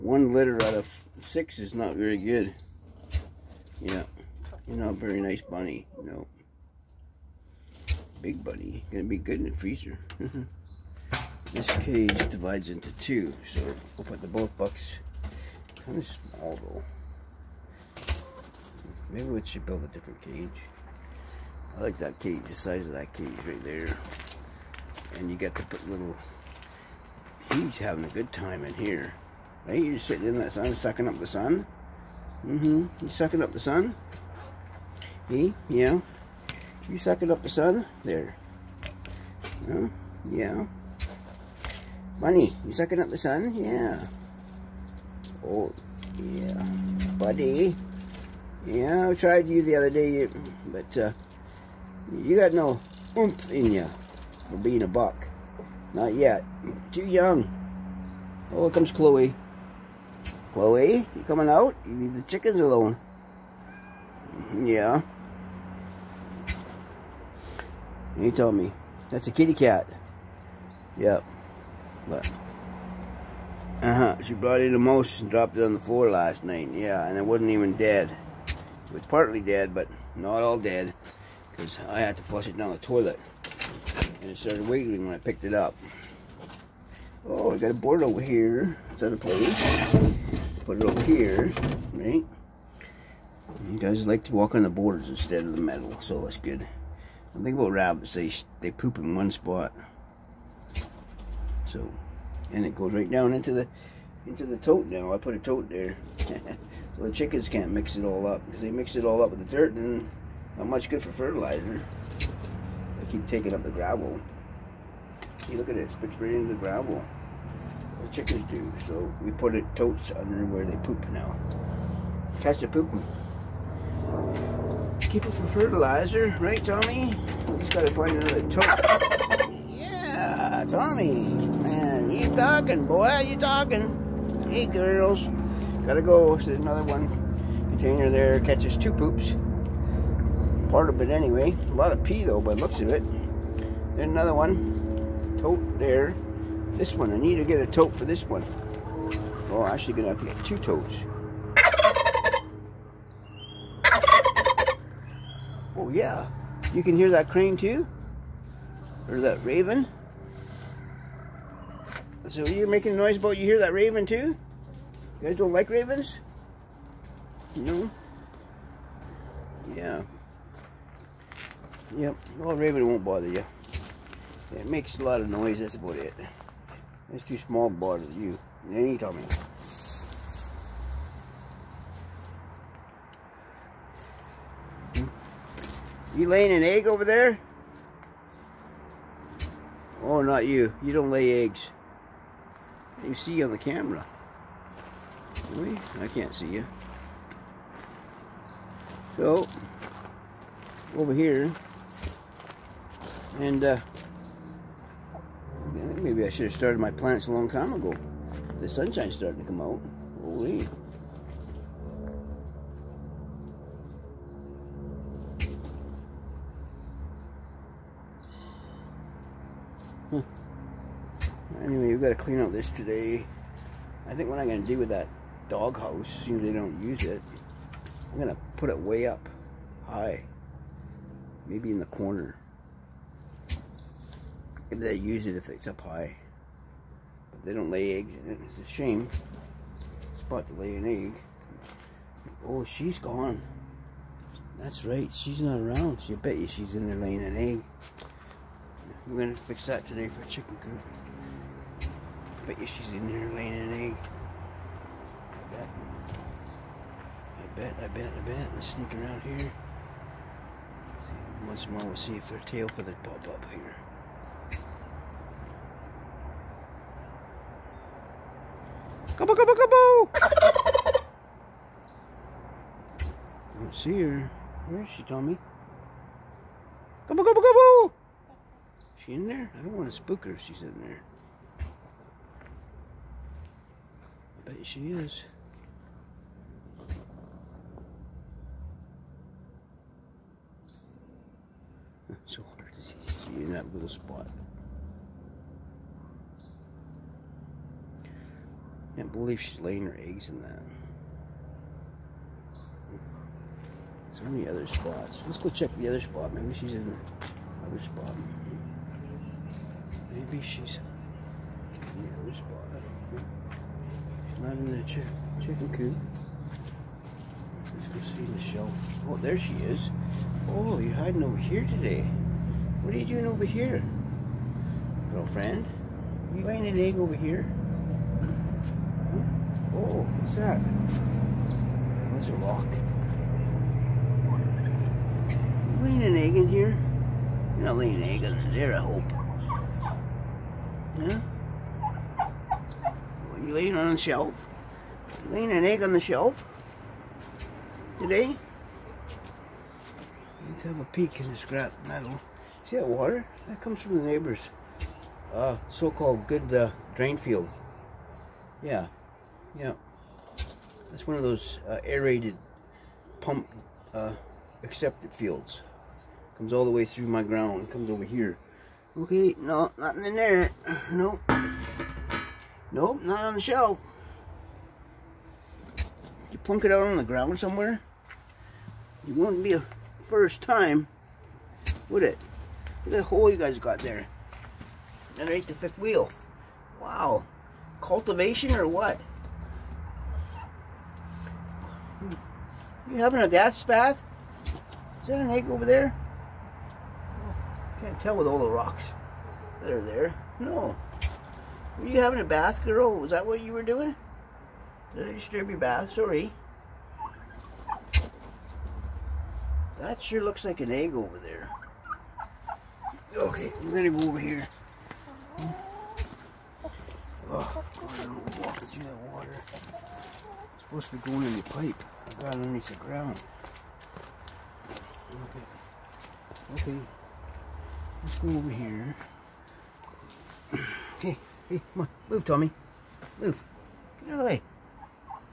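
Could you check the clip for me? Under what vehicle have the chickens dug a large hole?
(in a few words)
Fifth wheel.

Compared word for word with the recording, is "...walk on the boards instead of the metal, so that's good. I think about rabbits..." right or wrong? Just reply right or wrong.
right.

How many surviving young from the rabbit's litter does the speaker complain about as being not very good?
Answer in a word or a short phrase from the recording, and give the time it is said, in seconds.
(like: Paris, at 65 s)
6, at 1 s.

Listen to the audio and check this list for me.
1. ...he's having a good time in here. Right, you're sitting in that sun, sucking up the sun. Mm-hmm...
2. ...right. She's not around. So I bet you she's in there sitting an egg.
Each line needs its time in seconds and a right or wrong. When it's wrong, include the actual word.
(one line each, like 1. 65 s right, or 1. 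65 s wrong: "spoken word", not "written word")
1. 27 s right
2. 244 s wrong: "laying", not "sitting".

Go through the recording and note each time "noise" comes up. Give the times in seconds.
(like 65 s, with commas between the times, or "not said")
162 s, 175 s.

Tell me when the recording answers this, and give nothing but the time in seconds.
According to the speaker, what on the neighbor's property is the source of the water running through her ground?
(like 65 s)
356 s.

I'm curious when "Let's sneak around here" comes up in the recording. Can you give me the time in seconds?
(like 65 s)
258 s.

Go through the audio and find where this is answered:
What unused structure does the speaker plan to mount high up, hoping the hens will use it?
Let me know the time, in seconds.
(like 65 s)
225 s.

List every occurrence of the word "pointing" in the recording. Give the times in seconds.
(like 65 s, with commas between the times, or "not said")
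not said.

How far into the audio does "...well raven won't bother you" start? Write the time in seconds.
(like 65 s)
172 s.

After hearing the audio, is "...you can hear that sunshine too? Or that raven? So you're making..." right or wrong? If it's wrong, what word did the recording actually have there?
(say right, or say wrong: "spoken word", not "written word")
wrong: "crane", not "sunshine".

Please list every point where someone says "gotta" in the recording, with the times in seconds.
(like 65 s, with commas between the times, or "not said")
127 s, 135 s.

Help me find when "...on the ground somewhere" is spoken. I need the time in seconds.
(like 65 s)
376 s.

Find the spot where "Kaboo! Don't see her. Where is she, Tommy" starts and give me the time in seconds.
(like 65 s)
270 s.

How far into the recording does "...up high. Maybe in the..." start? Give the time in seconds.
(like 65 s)
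229 s.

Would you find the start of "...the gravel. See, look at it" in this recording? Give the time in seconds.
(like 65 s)
113 s.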